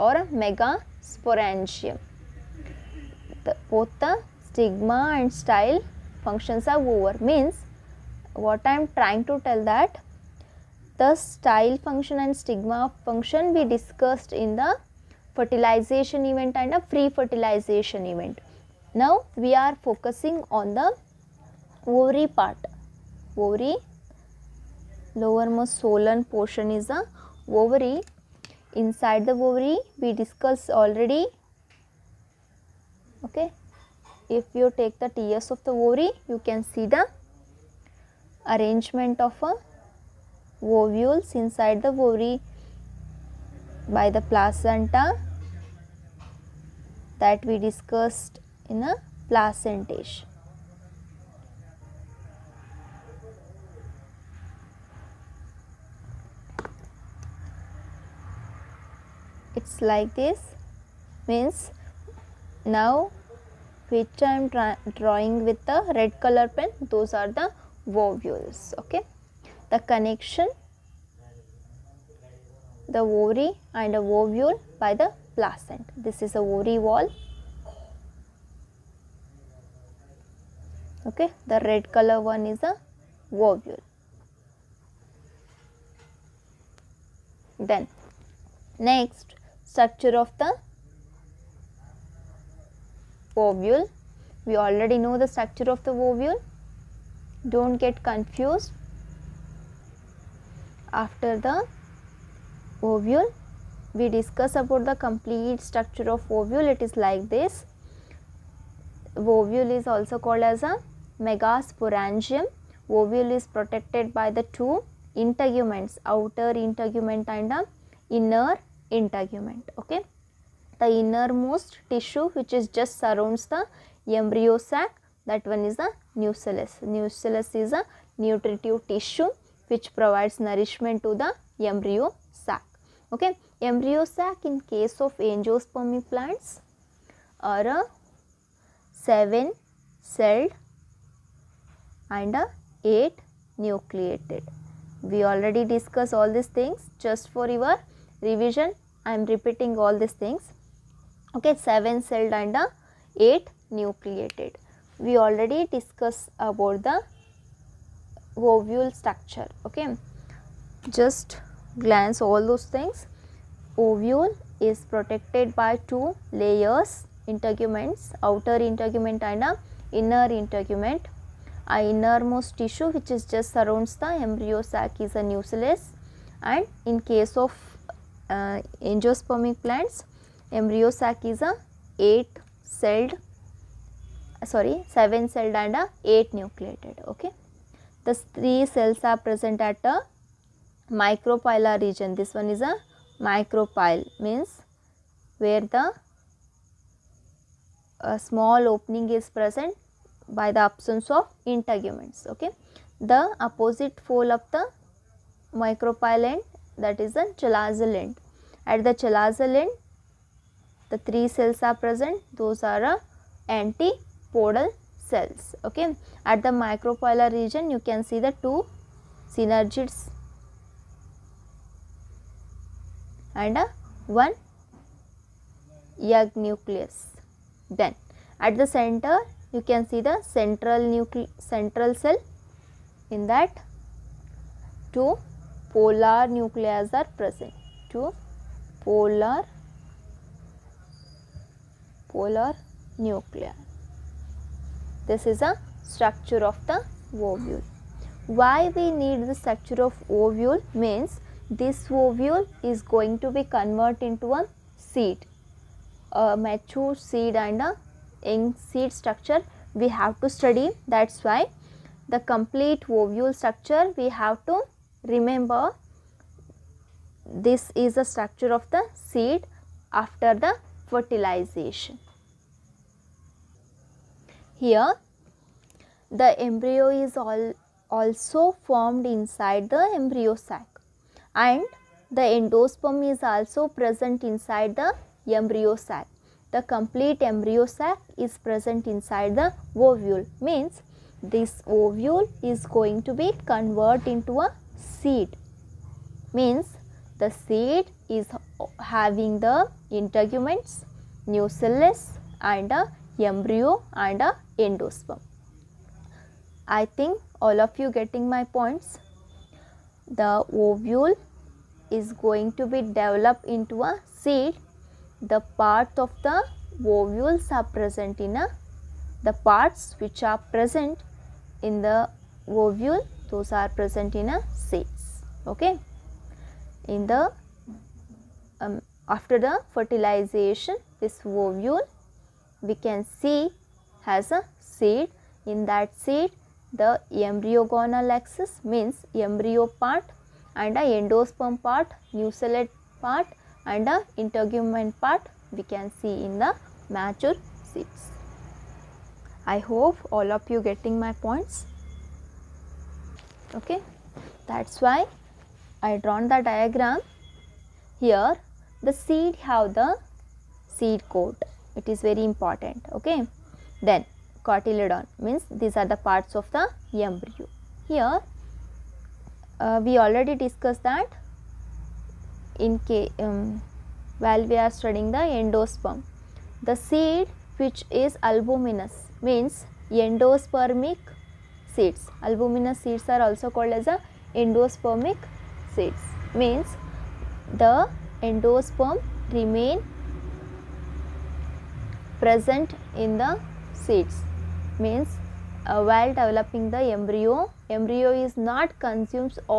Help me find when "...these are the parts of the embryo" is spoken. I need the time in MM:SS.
06:05.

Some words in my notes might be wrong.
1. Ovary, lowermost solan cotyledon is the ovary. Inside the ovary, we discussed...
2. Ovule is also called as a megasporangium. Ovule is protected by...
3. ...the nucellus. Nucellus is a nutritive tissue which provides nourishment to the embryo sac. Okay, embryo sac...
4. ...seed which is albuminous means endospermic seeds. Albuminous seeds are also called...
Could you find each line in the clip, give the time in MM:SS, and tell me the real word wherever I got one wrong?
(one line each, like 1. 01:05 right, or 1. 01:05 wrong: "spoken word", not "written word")
1. 00:23 wrong: "portion", not "cotyledon"
2. 01:49 right
3. 02:05 right
4. 06:16 right.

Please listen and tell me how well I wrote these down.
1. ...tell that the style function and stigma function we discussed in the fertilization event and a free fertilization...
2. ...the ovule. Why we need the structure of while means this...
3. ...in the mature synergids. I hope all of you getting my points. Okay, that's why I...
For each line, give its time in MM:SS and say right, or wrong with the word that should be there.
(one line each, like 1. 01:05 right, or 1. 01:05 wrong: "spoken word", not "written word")
1. 00:09 right
2. 04:06 wrong: "ovule", not "while"
3. 05:46 wrong: "seeds", not "synergids".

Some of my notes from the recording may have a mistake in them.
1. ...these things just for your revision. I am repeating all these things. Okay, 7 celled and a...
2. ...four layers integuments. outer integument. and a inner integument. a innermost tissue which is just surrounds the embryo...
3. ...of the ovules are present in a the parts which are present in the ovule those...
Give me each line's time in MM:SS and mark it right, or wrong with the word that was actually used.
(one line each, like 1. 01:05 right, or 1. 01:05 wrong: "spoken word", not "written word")
1. 02:26 right
2. 02:45 wrong: "two", not "four"
3. 05:15 right.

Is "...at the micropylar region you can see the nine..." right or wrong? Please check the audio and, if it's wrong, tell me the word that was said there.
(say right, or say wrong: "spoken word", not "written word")
wrong: "two", not "nine".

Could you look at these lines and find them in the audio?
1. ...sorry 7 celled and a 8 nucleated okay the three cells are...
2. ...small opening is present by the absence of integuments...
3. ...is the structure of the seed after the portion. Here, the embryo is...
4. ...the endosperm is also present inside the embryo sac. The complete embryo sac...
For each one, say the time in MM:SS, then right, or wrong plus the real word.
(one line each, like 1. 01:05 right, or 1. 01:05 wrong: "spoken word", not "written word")
1. 03:04 right
2. 03:18 right
3. 04:27 wrong: "fertilization", not "portion"
4. 04:42 right.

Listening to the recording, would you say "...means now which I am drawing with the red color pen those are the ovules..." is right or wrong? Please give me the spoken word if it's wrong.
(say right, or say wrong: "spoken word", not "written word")
right.